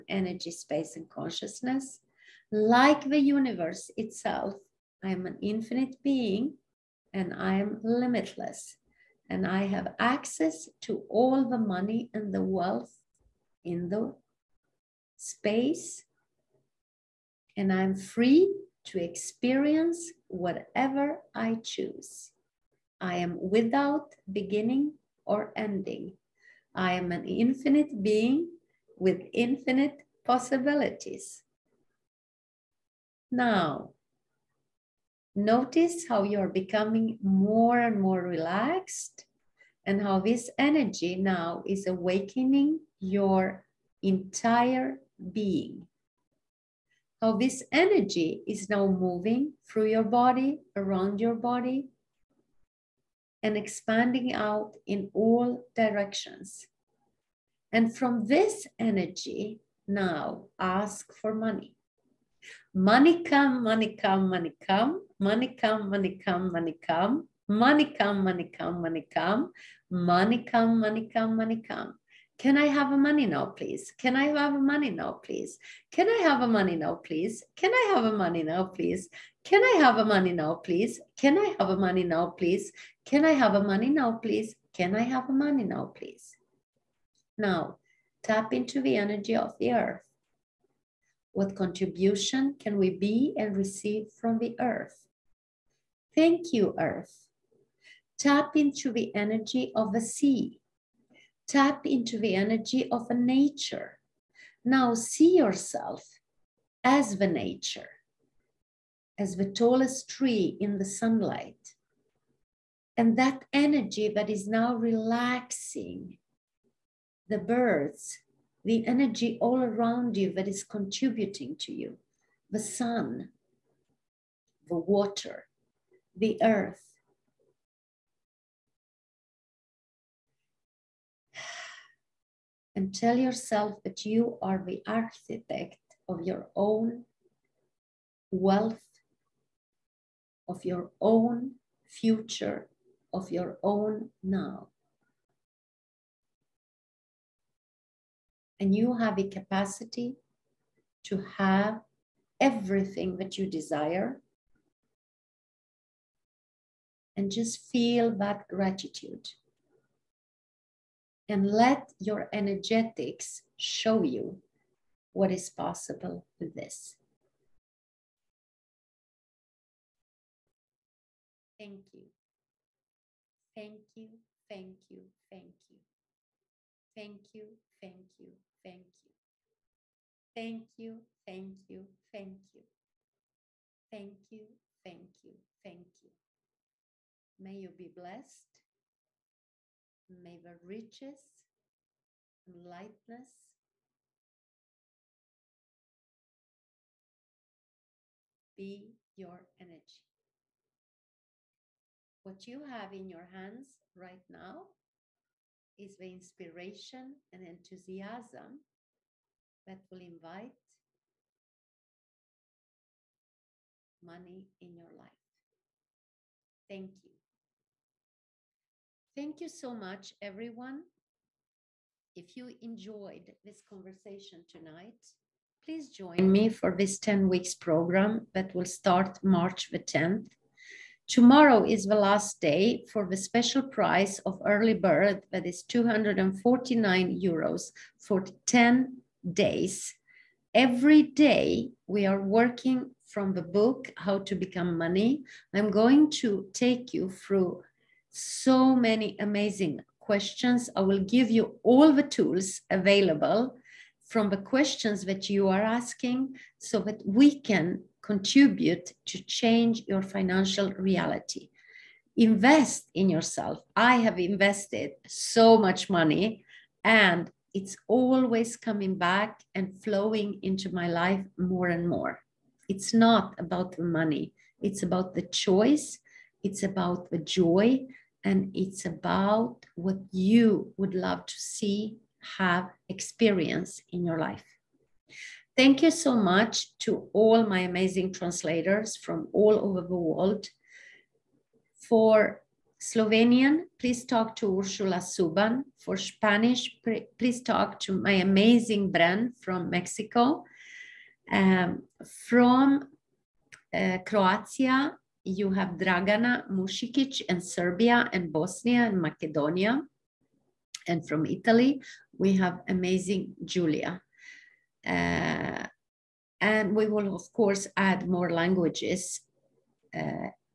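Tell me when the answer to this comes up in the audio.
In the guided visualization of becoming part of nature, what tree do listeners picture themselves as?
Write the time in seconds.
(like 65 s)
109 s.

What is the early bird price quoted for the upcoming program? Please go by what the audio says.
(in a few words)
249 euros.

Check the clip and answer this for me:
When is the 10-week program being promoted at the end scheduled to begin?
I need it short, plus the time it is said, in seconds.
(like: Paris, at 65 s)
March 10, at 229 s.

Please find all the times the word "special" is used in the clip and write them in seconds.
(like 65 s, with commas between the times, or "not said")
233 s.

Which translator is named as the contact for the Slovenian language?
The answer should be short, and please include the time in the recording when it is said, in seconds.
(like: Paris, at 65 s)
Ursula Suban, at 294 s.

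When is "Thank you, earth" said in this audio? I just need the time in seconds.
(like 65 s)
96 s.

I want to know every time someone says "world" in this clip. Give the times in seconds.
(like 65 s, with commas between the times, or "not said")
290 s.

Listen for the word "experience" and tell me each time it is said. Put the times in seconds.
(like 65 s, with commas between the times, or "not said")
19 s, 282 s.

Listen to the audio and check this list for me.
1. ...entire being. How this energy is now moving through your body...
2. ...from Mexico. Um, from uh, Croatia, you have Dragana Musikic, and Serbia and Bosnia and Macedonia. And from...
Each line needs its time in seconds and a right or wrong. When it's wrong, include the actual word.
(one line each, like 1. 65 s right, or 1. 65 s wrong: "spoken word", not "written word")
1. 44 s right
2. 299 s right.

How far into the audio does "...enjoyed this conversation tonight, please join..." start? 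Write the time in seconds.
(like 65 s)
222 s.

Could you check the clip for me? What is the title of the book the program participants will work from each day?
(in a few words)
How to Become Money.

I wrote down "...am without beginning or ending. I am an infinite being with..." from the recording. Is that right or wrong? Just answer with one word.
right.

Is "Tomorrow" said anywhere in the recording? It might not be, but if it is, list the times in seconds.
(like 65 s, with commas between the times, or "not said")
231 s.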